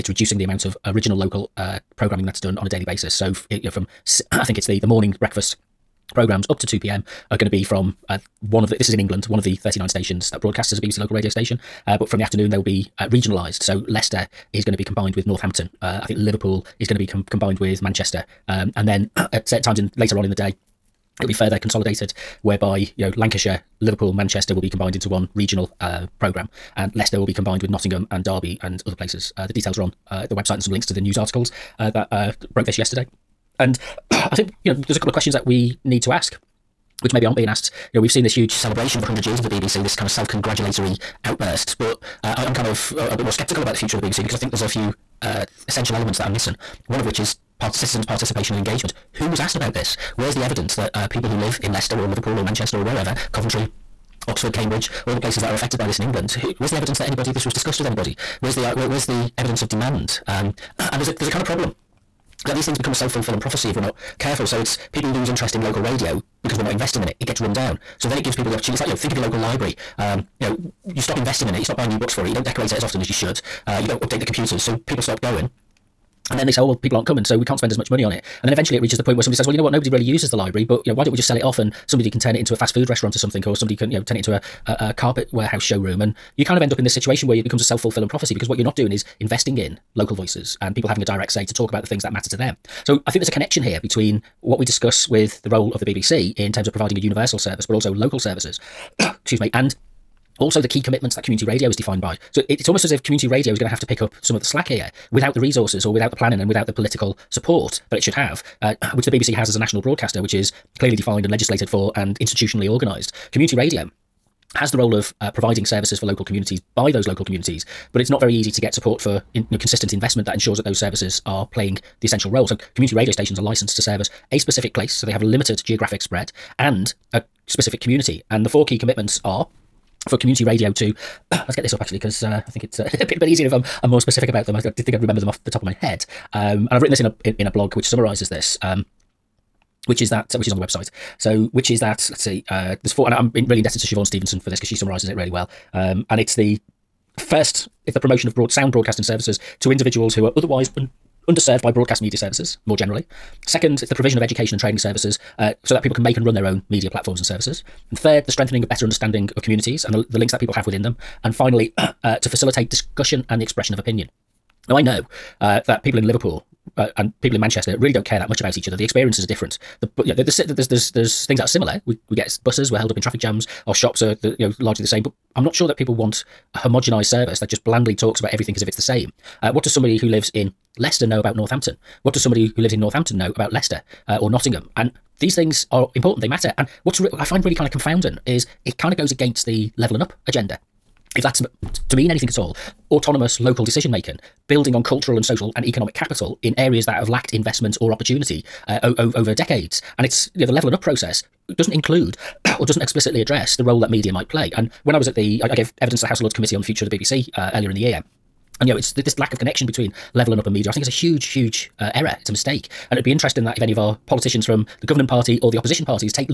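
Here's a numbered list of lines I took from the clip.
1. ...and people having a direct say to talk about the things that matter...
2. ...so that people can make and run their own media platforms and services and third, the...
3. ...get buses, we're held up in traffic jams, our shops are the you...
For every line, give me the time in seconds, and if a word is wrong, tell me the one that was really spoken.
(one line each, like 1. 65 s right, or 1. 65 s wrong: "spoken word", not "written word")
1. 90 s right
2. 155 s right
3. 172 s right.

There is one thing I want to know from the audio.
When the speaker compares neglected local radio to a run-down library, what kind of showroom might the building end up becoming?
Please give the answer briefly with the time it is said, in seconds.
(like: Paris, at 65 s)
carpet warehouse showroom, at 84 s.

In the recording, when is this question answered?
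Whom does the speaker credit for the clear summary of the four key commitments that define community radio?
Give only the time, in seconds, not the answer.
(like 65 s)
143 s.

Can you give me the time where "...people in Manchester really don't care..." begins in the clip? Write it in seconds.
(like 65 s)
167 s.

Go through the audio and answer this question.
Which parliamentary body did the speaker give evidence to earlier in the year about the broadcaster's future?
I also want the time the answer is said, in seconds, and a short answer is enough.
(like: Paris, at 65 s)
House of Lords Committee, at 206 s.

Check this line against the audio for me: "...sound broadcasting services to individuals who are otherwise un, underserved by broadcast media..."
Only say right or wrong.
right.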